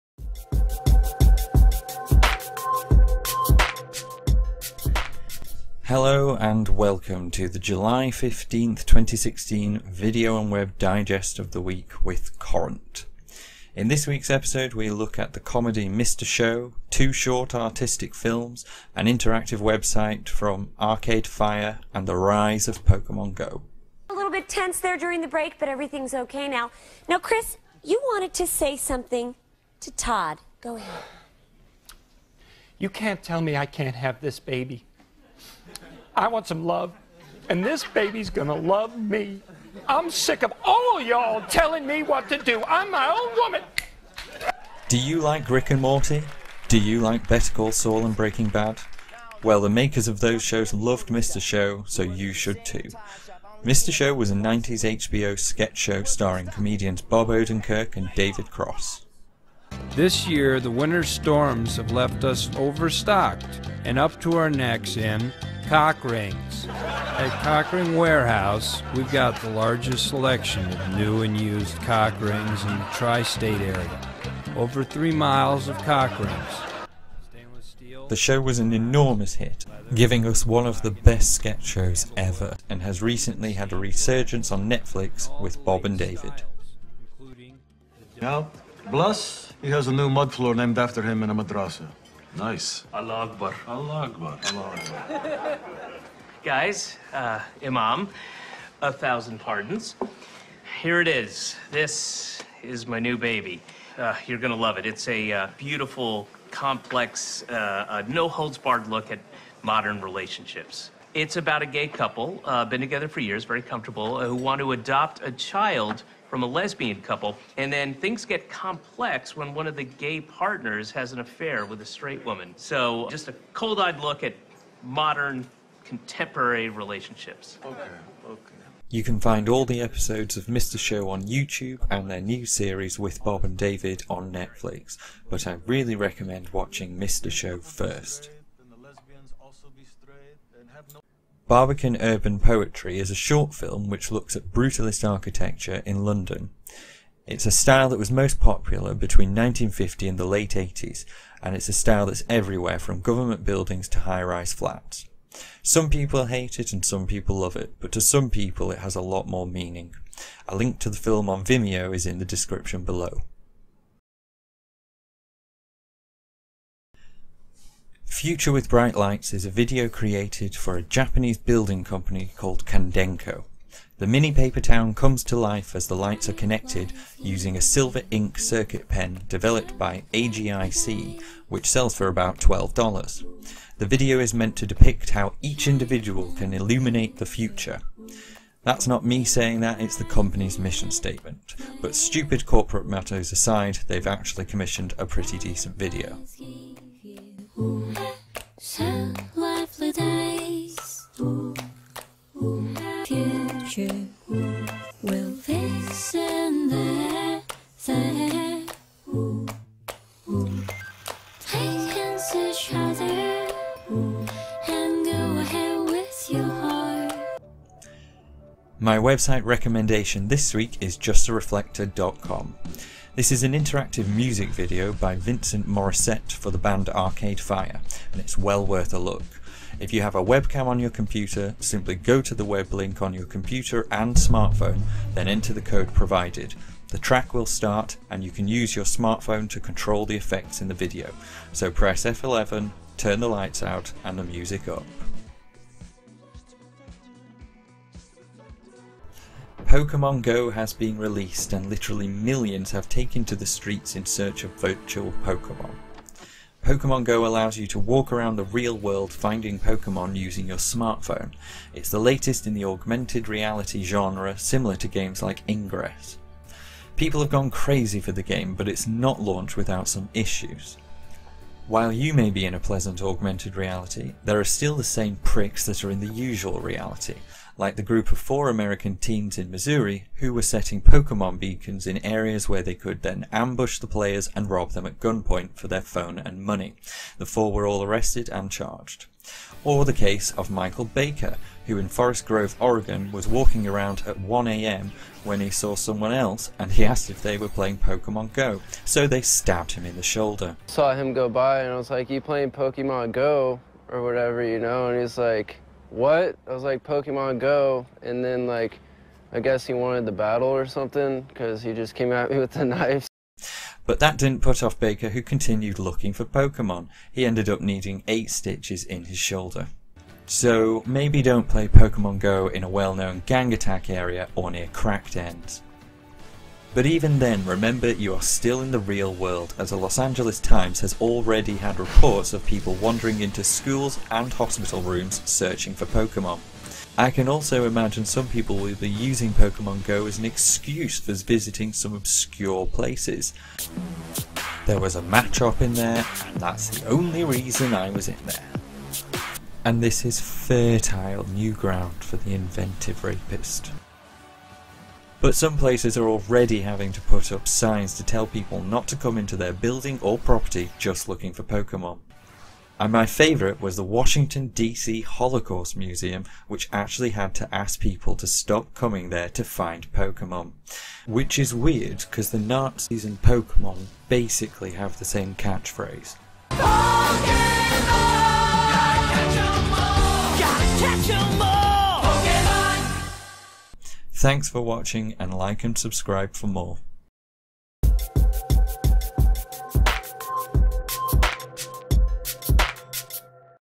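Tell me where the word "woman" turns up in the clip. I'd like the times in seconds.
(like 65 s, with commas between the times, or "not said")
43 s, 122 s.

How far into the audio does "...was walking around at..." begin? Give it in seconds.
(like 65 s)
293 s.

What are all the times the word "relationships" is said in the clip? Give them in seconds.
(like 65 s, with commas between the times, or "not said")
110 s, 126 s.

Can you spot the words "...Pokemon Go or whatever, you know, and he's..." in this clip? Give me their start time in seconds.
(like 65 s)
302 s.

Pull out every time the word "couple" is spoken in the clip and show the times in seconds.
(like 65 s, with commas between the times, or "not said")
111 s, 117 s.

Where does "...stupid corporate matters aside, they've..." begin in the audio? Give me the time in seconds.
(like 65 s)
191 s.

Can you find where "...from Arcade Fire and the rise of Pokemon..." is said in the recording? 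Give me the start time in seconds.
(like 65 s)
20 s.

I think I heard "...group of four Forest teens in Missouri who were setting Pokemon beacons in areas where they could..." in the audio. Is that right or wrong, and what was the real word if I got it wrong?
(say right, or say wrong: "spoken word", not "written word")
wrong: "American", not "Forest".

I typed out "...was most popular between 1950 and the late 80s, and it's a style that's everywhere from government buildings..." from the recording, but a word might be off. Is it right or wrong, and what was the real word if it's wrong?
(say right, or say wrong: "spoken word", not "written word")
right.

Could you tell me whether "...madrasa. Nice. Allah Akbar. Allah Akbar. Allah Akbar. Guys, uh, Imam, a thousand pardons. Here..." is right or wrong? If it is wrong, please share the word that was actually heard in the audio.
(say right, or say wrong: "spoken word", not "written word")
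right.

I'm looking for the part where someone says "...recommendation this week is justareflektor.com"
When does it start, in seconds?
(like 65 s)
219 s.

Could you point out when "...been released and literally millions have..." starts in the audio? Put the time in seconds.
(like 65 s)
250 s.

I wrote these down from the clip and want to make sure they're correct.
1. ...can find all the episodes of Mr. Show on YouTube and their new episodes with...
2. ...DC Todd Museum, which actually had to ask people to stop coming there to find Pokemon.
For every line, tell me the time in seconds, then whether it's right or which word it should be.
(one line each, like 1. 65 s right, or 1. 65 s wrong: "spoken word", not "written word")
1. 129 s wrong: "series", not "episodes"
2. 364 s wrong: "Holocaust", not "Todd".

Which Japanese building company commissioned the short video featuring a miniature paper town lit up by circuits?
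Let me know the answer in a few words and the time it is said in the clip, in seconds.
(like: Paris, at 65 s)
Kandenko, at 172 s.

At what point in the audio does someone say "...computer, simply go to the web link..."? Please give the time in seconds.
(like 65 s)
230 s.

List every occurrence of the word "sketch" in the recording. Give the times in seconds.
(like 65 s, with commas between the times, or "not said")
55 s, 81 s.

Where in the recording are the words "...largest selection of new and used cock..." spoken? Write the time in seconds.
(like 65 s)
69 s.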